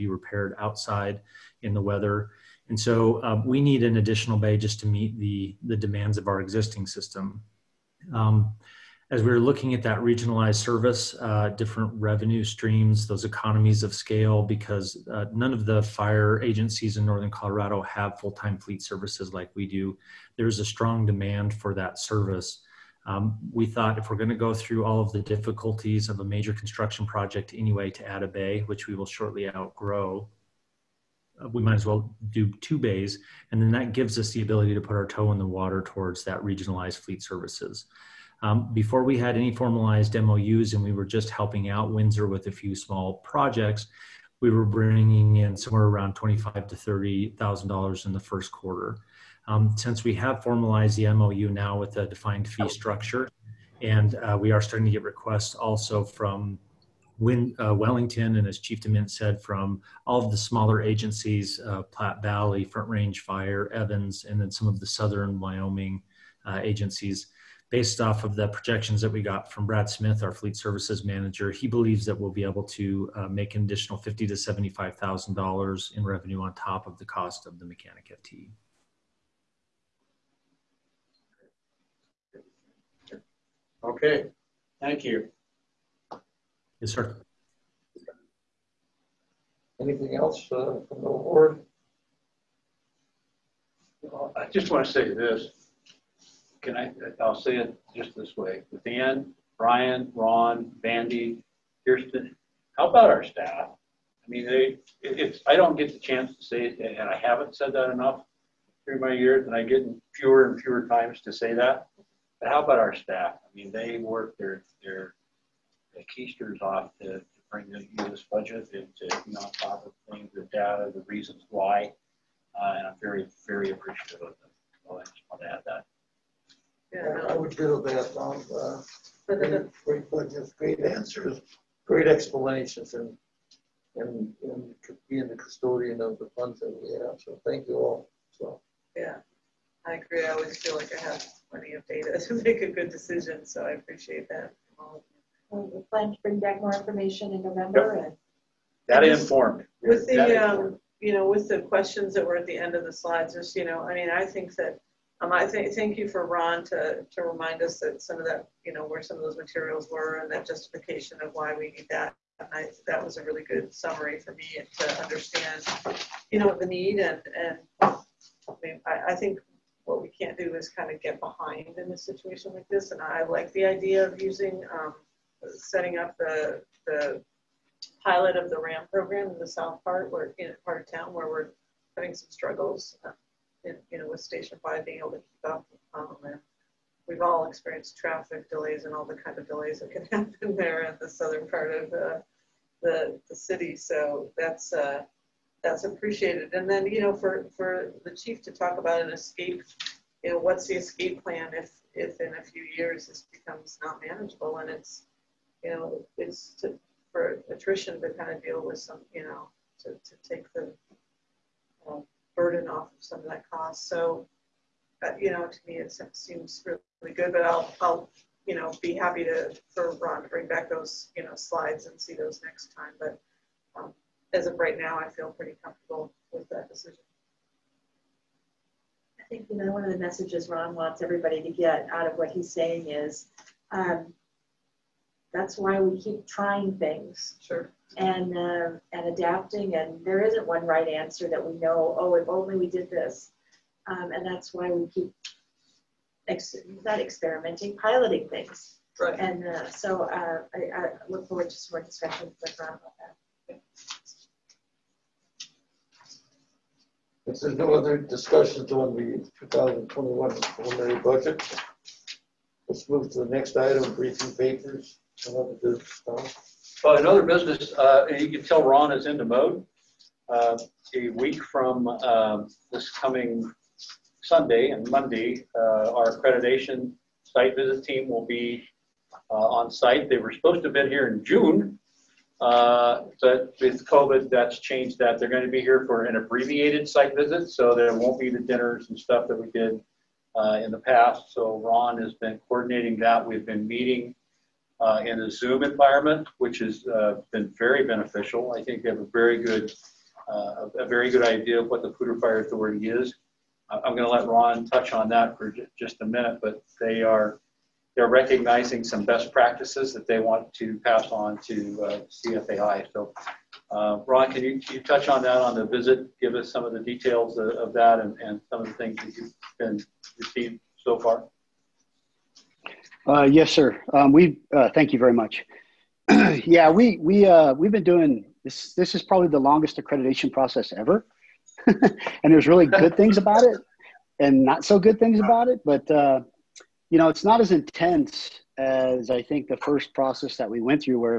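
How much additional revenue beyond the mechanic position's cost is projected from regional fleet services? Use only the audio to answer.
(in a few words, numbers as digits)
$50,000 to $75,000.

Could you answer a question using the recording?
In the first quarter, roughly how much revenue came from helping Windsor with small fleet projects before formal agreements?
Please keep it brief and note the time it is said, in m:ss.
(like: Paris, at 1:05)
$25,000 to $30,000, at 0:46.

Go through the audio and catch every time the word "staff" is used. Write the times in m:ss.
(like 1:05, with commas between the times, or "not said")
1:43, 1:52.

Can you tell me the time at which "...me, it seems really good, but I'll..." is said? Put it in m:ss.
3:35.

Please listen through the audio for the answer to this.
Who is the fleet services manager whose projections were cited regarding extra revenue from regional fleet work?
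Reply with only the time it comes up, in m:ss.
1:09.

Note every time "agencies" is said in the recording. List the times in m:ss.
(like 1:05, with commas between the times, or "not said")
0:16, 1:00, 1:06.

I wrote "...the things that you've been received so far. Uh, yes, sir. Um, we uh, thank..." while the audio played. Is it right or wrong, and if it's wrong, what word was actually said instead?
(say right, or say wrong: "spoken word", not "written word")
right.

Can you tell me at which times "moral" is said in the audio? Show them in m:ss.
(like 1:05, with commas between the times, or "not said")
not said.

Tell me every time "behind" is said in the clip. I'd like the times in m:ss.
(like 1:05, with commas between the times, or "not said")
2:51.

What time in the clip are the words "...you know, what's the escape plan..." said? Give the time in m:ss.
3:20.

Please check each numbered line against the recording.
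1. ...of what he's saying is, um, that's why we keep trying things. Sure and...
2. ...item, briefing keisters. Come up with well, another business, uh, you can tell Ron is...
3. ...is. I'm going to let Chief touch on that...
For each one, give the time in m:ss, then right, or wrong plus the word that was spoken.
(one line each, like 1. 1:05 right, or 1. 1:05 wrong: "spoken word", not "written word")
1. 3:52 right
2. 4:23 wrong: "papers", not "keisters"
3. 5:02 wrong: "Ron", not "Chief".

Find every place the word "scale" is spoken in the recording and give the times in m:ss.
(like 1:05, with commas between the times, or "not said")
0:13.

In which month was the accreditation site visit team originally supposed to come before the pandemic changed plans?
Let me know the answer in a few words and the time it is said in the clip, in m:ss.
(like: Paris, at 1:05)
June, at 4:41.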